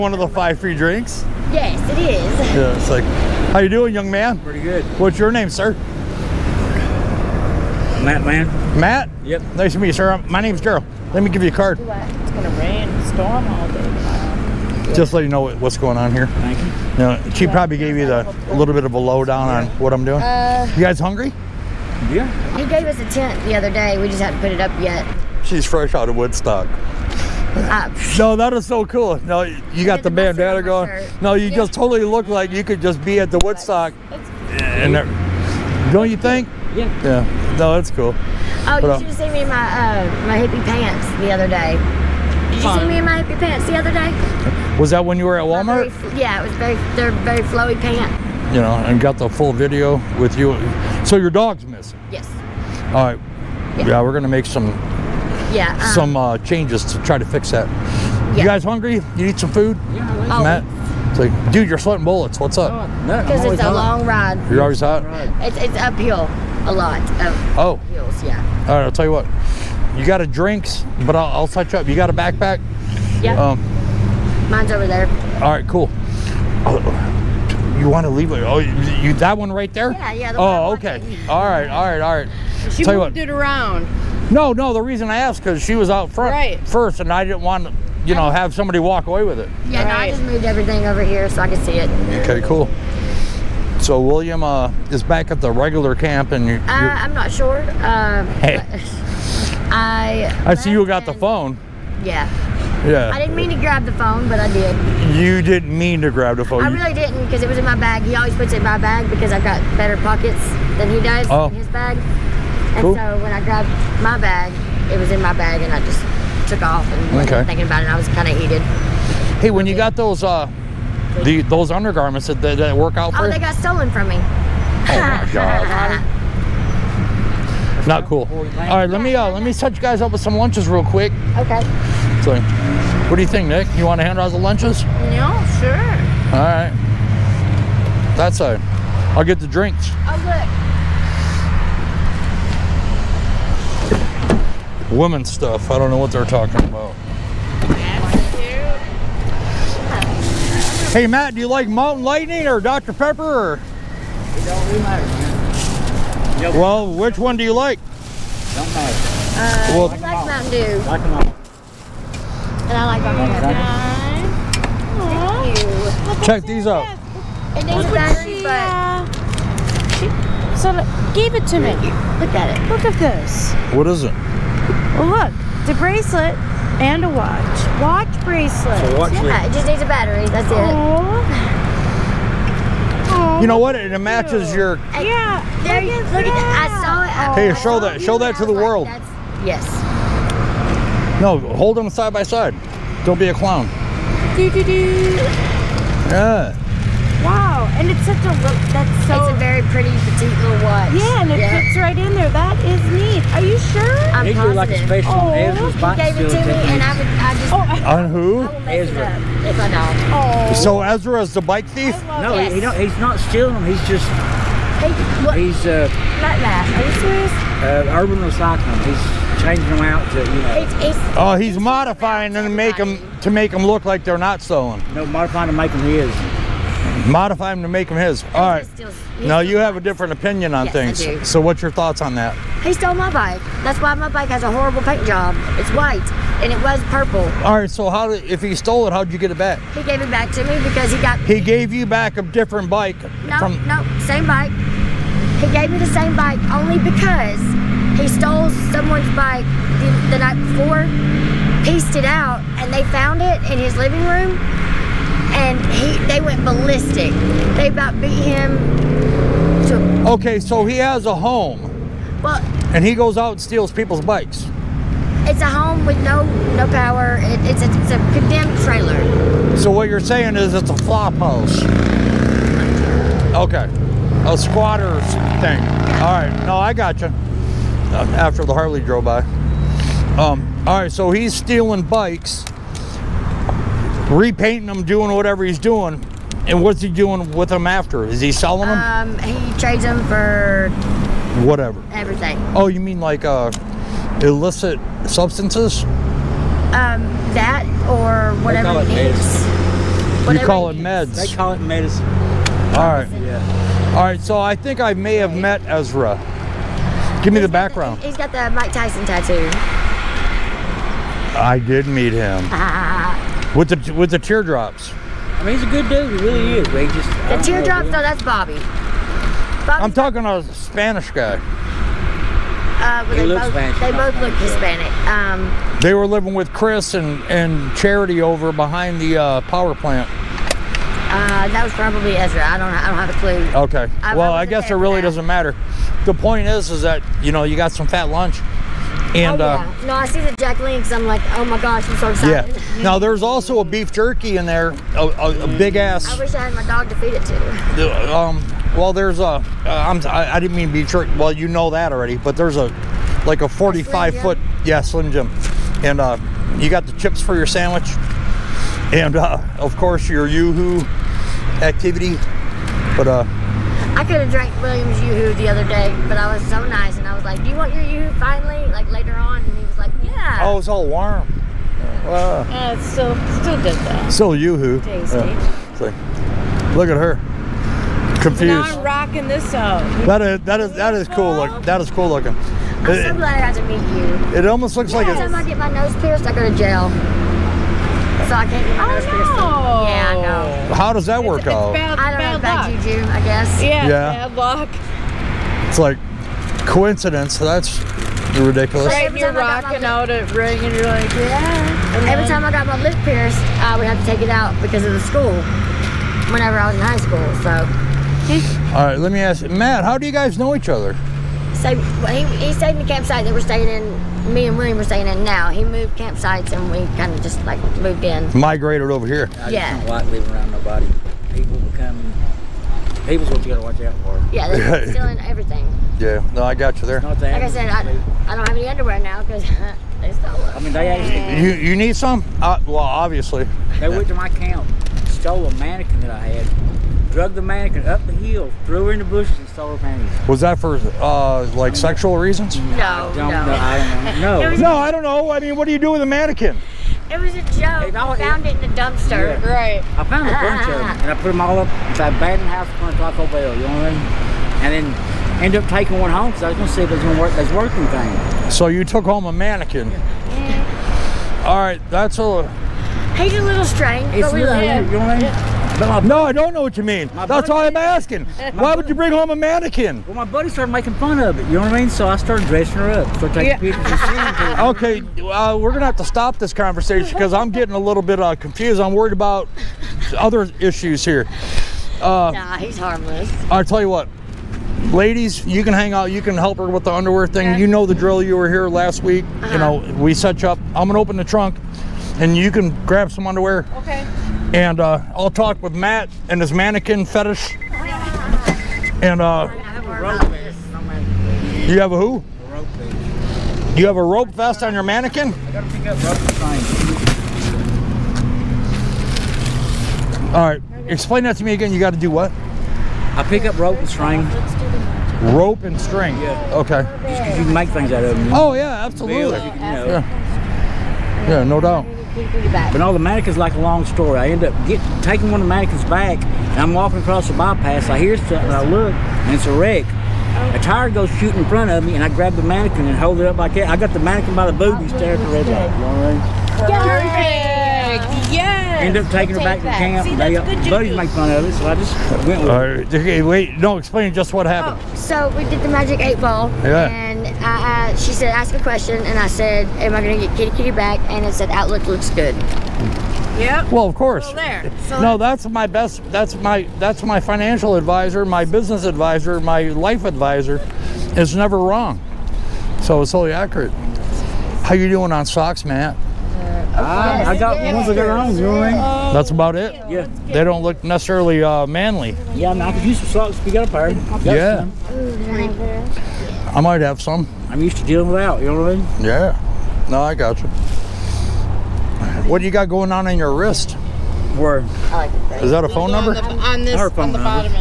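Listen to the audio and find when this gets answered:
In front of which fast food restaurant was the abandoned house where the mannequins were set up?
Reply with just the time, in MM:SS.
07:33.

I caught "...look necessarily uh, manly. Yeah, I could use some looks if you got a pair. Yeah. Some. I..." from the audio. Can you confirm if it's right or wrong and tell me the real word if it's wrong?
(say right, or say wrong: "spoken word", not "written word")
wrong: "socks", not "looks".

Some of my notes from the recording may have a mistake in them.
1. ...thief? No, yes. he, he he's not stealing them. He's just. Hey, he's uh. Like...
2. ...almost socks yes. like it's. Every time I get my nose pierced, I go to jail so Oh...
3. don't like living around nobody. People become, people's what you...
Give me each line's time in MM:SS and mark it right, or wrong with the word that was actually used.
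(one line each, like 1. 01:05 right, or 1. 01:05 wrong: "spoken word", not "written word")
1. 03:31 right
2. 06:24 wrong: "looks", not "socks"
3. 06:59 right.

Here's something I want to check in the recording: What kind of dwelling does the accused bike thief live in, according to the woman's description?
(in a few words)
A condemned trailer.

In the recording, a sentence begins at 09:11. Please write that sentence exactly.
And it said, outlook looks good.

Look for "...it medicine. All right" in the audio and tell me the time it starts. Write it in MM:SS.
05:01.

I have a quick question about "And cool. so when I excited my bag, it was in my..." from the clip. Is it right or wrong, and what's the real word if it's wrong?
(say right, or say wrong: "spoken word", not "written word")
wrong: "grabbed", not "excited".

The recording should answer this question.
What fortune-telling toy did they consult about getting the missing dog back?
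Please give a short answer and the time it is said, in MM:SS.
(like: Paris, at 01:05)
Magic eight ball, at 09:05.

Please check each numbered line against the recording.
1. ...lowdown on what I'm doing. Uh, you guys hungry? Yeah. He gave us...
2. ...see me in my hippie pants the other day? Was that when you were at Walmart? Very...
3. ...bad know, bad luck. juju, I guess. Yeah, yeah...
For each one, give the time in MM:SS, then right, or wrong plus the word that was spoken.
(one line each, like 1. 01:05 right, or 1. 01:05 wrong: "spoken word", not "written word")
1. 00:18 right
2. 00:42 right
3. 06:32 right.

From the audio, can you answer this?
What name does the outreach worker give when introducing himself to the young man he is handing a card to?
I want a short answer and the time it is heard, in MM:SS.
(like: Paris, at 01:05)
Gerald, at 00:10.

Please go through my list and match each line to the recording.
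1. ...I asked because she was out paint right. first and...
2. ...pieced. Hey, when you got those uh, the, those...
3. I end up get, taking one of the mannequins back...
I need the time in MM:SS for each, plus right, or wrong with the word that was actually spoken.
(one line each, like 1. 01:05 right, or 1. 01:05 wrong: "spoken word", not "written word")
1. 01:25 wrong: "front", not "paint"
2. 01:58 wrong: "heated", not "pieced"
3. 08:44 right.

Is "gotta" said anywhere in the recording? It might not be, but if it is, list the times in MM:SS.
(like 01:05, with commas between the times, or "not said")
07:03, 08:25.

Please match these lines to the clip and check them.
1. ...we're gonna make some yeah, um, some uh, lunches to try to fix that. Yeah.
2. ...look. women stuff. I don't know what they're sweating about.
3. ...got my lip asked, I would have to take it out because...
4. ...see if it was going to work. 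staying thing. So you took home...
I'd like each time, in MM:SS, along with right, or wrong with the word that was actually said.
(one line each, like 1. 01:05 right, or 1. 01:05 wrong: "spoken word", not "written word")
1. 00:54 wrong: "changes", not "lunches"
2. 02:20 wrong: "talking", not "sweating"
3. 06:42 wrong: "pierced", not "asked"
4. 07:36 wrong: "working", not "staying".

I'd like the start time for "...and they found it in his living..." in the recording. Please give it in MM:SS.
04:12.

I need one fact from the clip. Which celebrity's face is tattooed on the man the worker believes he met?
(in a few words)
Mike Tyson.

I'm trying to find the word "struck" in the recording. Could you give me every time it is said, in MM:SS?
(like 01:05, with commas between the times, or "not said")
not said.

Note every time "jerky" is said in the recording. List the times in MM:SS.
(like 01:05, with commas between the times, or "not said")
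05:43, 05:50.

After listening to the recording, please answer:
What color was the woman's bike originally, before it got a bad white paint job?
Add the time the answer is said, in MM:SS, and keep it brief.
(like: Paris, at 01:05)
Purple, at 03:56.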